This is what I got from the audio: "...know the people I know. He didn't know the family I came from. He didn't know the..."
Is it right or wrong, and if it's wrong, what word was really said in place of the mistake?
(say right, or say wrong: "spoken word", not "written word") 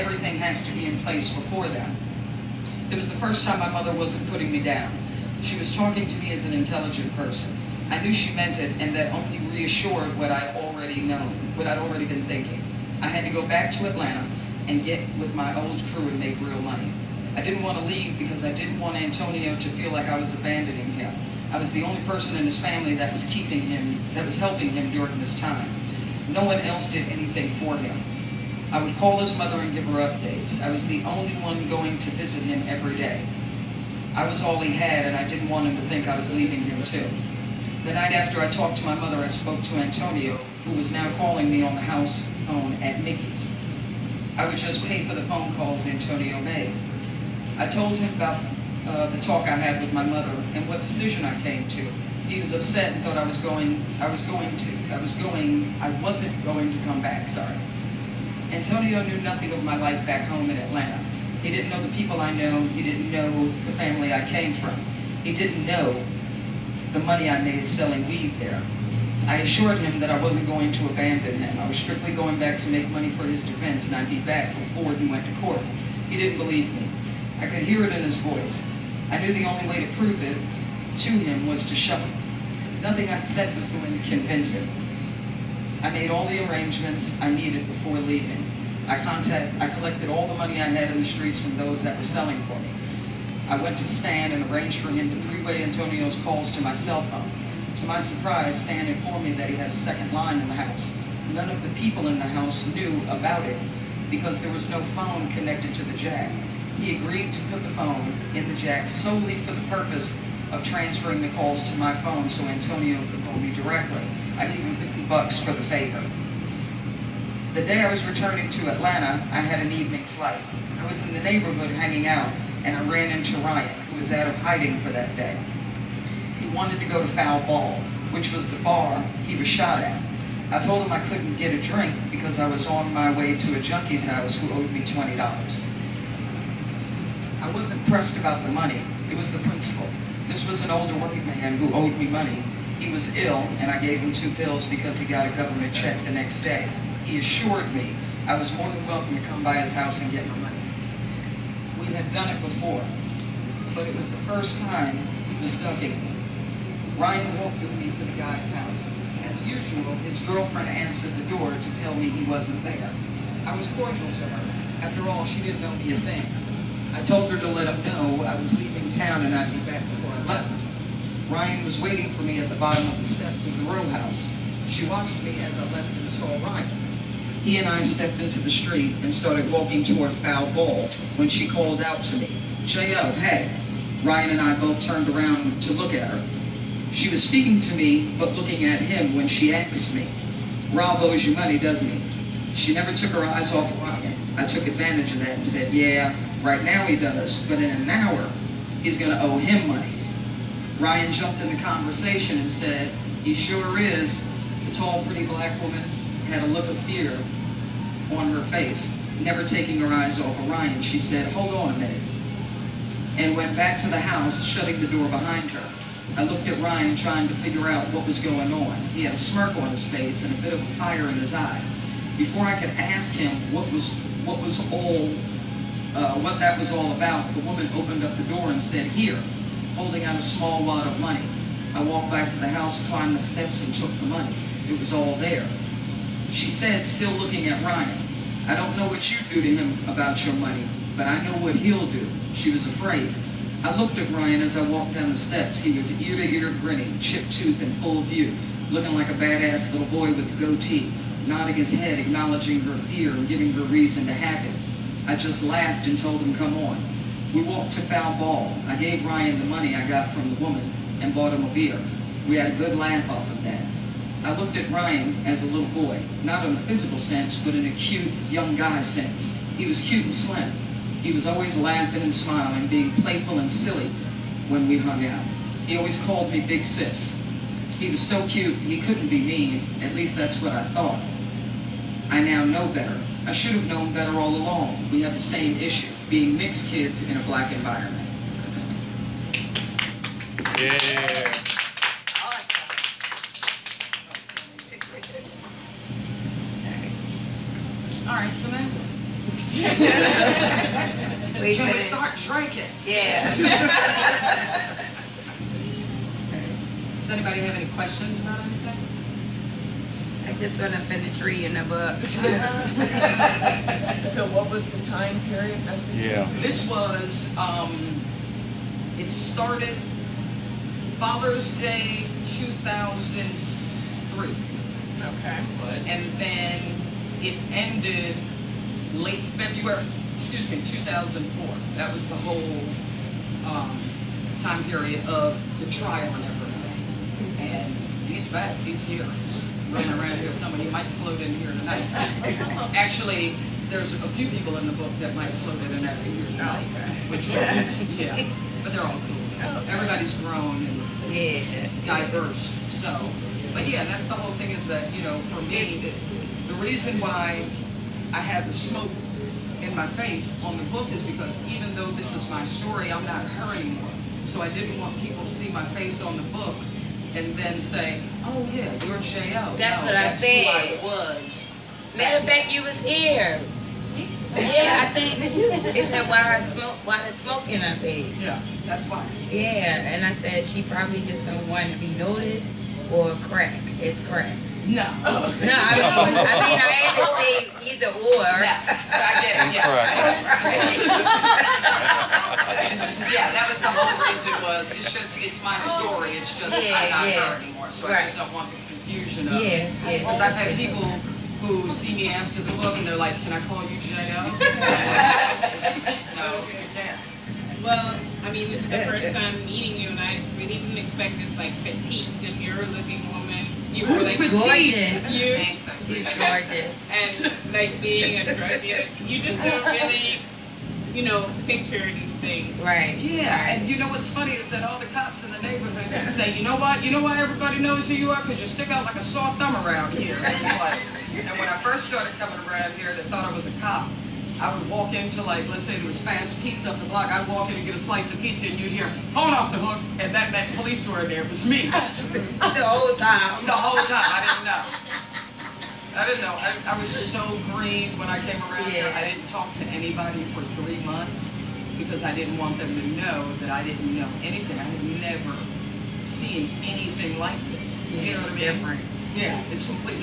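right.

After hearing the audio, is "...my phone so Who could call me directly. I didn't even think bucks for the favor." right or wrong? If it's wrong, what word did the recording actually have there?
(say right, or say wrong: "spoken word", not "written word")
wrong: "Antonio", not "Who".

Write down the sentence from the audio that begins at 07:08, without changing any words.
Because you stick out like a sore thumb around here.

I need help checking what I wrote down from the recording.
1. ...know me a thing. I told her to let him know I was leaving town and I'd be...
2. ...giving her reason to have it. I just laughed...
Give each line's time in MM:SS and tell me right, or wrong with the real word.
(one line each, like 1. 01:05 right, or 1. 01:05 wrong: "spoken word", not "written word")
1. 02:45 right
2. 04:13 right.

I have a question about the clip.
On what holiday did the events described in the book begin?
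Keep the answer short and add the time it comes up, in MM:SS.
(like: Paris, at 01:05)
Father's Day, at 05:20.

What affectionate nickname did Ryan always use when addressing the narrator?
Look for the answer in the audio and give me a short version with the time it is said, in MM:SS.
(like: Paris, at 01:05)
Big Sis, at 04:36.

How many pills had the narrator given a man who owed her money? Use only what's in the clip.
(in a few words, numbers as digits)
2.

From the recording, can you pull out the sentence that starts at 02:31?
We had done it before, but it was the first time he was ducking.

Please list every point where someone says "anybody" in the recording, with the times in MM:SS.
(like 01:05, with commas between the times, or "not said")
05:07, 07:29.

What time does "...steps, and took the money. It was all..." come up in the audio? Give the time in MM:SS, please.
03:53.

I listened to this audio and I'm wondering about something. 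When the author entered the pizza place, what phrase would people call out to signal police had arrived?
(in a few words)
phone off the hook.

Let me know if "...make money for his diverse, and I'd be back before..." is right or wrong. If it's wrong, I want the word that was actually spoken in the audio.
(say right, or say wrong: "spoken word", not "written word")
wrong: "defense", not "diverse".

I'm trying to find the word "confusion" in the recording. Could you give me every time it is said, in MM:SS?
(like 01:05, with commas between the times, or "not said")
06:38.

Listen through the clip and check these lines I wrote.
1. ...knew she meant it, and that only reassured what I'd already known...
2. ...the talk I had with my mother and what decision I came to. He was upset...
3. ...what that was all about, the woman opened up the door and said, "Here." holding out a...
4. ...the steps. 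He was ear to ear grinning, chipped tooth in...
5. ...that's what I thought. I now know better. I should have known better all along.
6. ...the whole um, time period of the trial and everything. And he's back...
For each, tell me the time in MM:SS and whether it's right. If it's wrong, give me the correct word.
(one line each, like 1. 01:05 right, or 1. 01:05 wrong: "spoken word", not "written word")
1. 00:08 right
2. 00:49 right
3. 03:46 right
4. 04:05 right
5. 04:40 right
6. 05:32 right.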